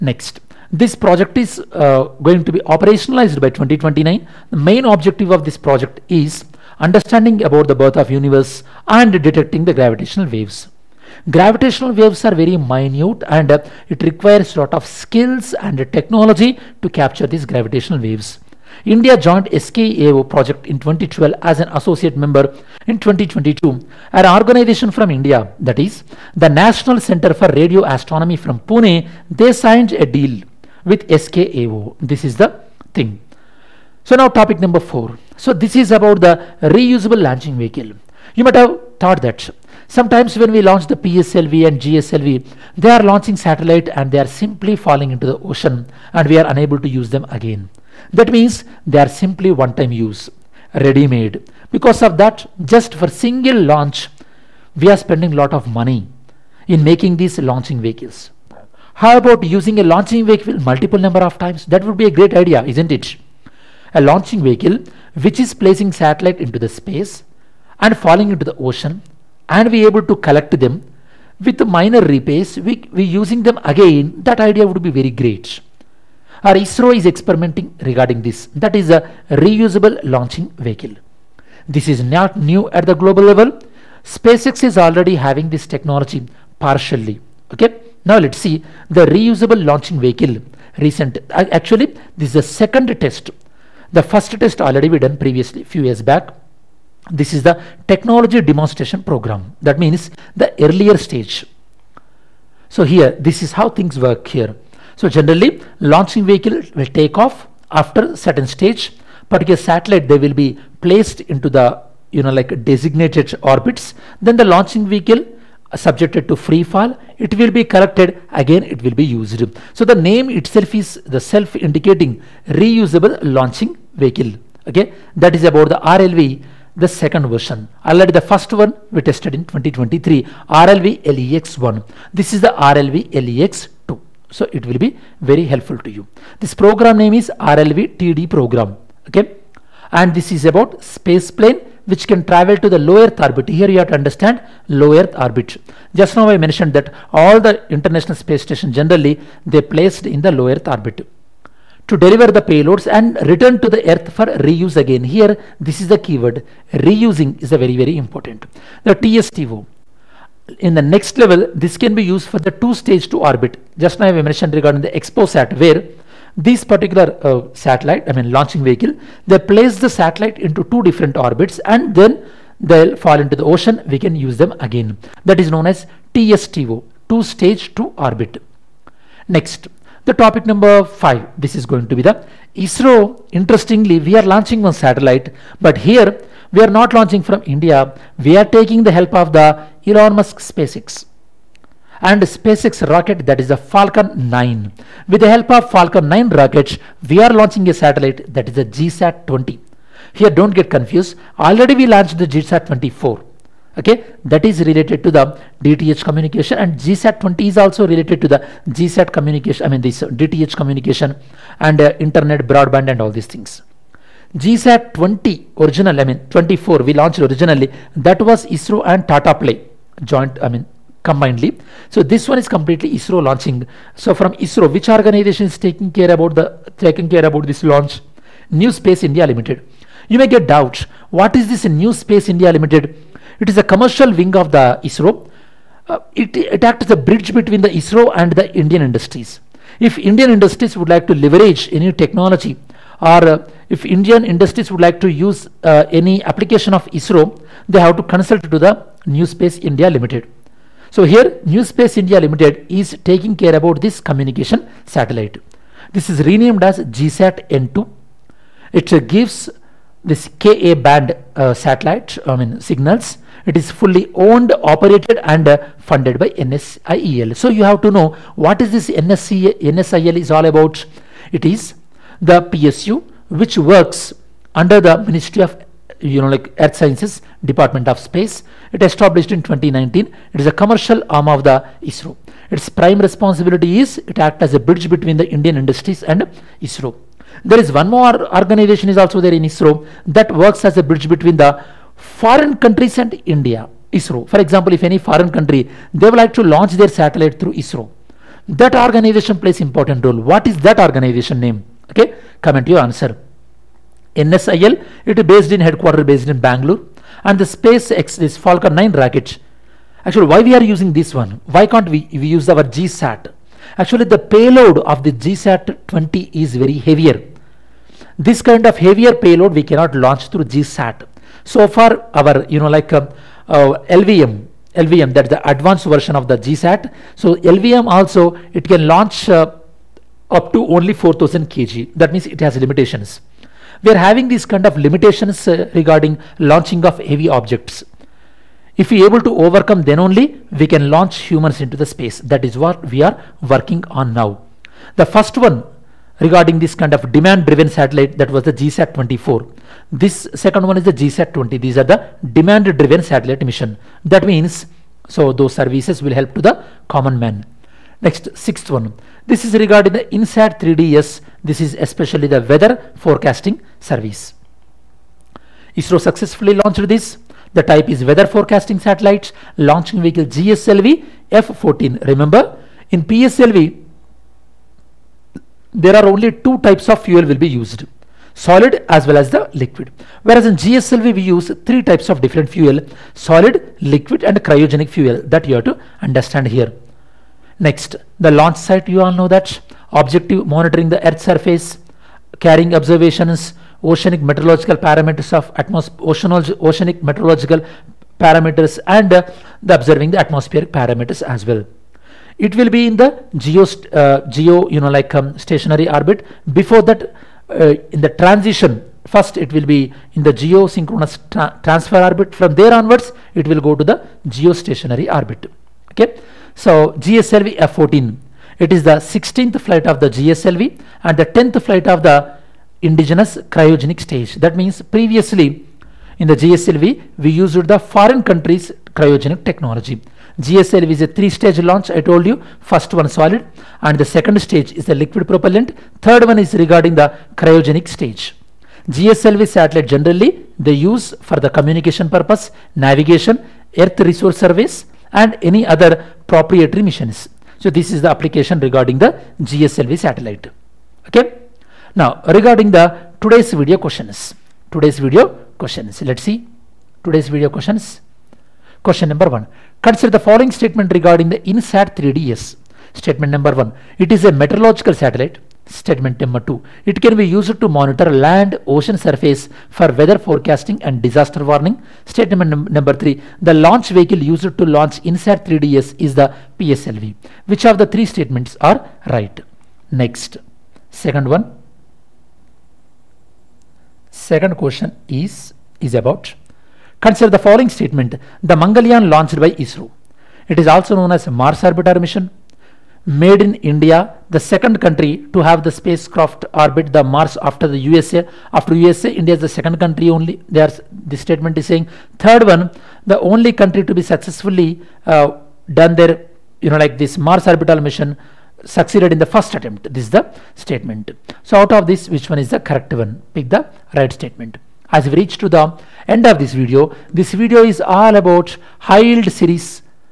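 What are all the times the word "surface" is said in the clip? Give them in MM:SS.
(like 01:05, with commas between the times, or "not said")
06:31, 07:48.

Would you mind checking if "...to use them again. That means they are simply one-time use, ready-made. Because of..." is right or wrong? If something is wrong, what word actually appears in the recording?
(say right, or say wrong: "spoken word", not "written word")
right.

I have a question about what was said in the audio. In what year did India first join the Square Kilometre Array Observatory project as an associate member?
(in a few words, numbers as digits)
2012.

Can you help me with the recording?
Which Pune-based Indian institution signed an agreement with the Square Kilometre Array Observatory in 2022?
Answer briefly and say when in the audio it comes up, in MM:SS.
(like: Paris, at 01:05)
National Center for Radio Astronomy, at 00:26.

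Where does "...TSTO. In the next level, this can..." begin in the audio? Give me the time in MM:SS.
02:38.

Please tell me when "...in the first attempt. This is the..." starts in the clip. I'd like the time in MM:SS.
08:29.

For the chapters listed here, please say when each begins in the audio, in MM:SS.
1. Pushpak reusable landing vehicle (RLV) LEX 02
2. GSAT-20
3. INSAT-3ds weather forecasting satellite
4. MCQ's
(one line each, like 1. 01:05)
1. 00:35
2. 03:11
3. 06:05
4. 07:40.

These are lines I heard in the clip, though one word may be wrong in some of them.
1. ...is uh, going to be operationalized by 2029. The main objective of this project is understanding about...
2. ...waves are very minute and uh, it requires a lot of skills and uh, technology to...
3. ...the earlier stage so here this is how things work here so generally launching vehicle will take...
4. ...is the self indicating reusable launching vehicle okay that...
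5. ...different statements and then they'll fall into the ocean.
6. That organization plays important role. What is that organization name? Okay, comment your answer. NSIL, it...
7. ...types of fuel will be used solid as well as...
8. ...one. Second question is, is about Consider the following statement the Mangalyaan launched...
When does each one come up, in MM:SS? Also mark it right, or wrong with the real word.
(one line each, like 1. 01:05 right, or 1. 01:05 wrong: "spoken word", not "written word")
1. 00:01 right
2. 00:11 right
3. 01:40 right
4. 02:00 right
5. 02:50 wrong: "orbits", not "statements"
6. 04:58 right
7. 06:16 right
8. 08:01 right.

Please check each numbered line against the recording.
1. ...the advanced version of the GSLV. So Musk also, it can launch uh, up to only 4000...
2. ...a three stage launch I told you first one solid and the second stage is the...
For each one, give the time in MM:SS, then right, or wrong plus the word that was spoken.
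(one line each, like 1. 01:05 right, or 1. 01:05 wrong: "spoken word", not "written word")
1. 05:25 wrong: "LVM", not "Musk"
2. 07:11 right.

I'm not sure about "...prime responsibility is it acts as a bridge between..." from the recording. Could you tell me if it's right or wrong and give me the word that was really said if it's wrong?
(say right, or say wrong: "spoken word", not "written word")
right.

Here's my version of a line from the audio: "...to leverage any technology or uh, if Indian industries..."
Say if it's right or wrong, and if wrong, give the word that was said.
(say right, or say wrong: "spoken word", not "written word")
right.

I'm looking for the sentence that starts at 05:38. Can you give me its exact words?
If we are able to overcome, then only we can launch humans into the space.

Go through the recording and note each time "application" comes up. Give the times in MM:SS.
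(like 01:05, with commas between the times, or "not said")
04:06, 07:28.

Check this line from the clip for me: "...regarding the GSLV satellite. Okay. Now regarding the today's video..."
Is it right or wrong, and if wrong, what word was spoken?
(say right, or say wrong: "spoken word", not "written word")
right.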